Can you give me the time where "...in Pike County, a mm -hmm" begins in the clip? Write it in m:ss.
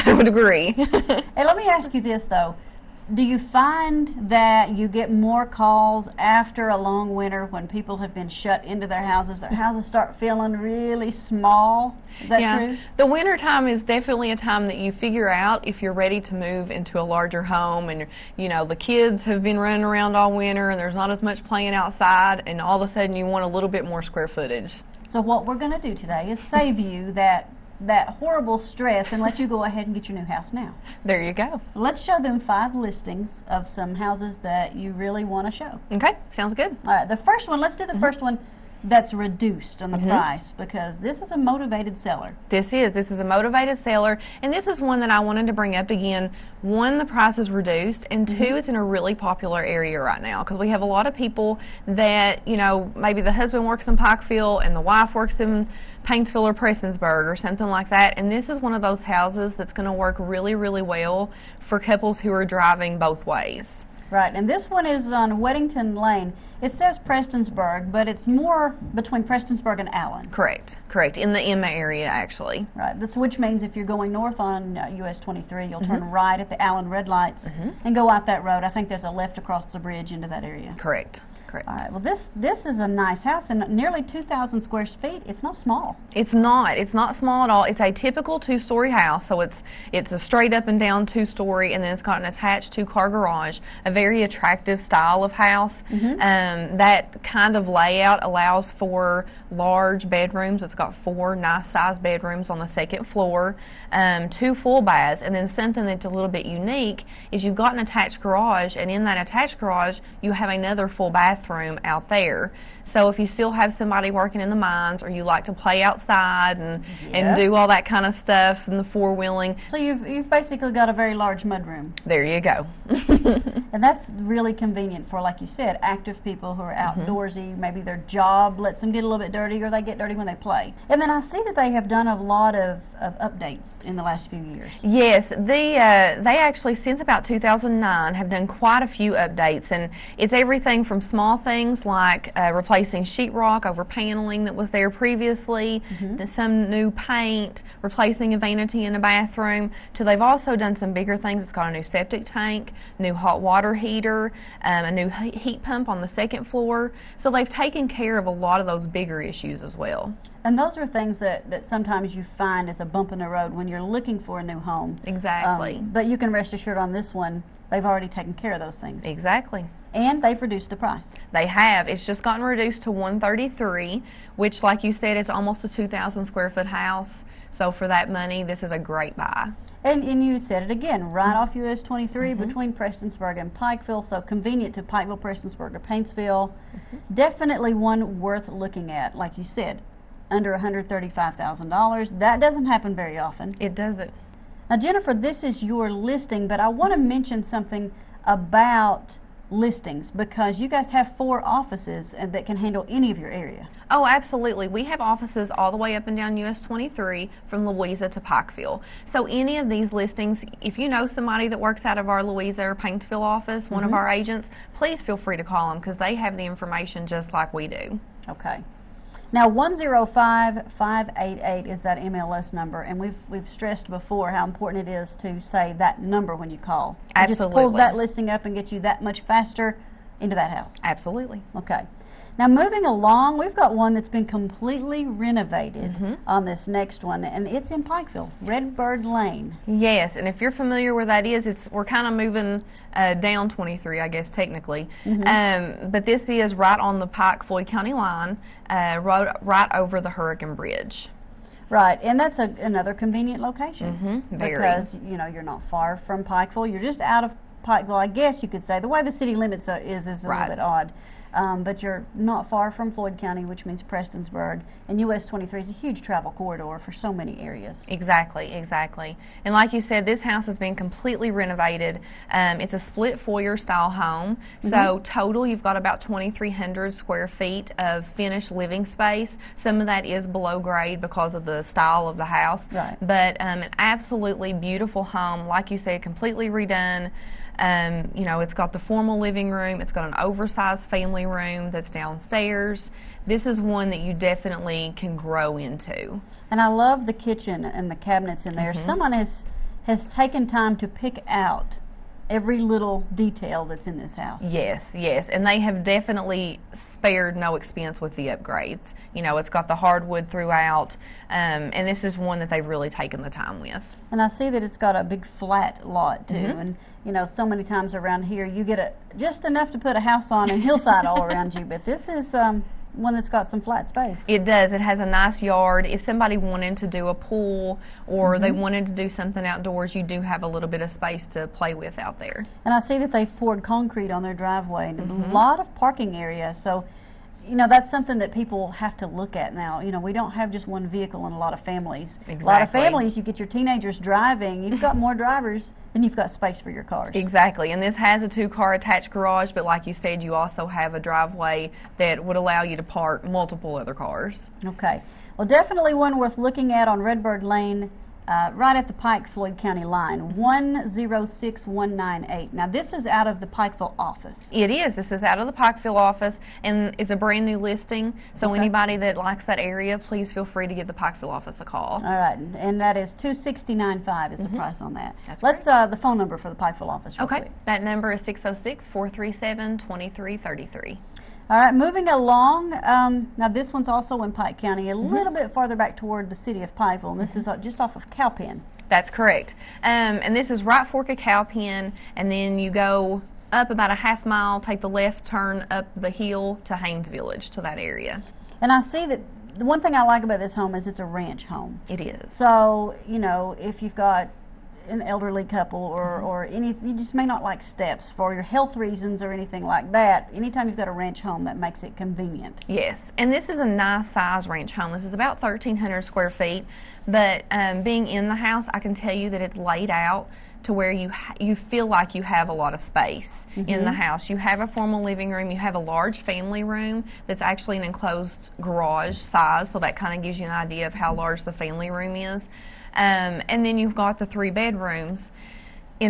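6:24.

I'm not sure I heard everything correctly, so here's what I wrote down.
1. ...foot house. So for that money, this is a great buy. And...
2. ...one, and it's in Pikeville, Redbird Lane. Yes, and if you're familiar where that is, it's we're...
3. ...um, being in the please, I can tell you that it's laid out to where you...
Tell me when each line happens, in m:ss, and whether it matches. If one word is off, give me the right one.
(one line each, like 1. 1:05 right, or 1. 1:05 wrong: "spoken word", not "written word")
1. 2:56 right
2. 3:57 right
3. 6:57 wrong: "house", not "please".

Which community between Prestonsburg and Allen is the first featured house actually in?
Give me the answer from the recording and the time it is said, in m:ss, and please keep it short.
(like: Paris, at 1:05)
Emma, at 1:11.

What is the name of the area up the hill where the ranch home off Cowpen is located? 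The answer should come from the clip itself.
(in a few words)
Haines Village.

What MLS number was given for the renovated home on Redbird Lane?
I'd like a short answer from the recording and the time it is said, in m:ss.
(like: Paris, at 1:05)
106198, at 6:00.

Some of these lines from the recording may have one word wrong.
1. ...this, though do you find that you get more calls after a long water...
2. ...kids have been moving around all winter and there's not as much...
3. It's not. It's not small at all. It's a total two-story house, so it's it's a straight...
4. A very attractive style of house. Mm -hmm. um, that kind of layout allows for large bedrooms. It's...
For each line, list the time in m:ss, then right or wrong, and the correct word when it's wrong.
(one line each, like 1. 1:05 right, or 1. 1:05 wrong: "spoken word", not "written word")
1. 0:02 wrong: "winter", not "water"
2. 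0:18 wrong: "running", not "moving"
3. 1:26 wrong: "typical", not "total"
4. 1:33 right.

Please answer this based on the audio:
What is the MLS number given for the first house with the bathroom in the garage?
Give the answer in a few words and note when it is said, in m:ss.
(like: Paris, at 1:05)
105588, at 3:39.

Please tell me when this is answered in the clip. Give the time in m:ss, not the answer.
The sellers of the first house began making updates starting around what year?
2:17.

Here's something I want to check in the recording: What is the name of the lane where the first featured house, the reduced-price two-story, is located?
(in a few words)
Weddington Lane.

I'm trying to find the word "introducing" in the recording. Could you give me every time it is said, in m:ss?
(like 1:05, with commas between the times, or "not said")
not said.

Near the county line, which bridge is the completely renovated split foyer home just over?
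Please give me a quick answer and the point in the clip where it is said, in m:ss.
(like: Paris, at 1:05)
Hurricane Bridge, at 4:10.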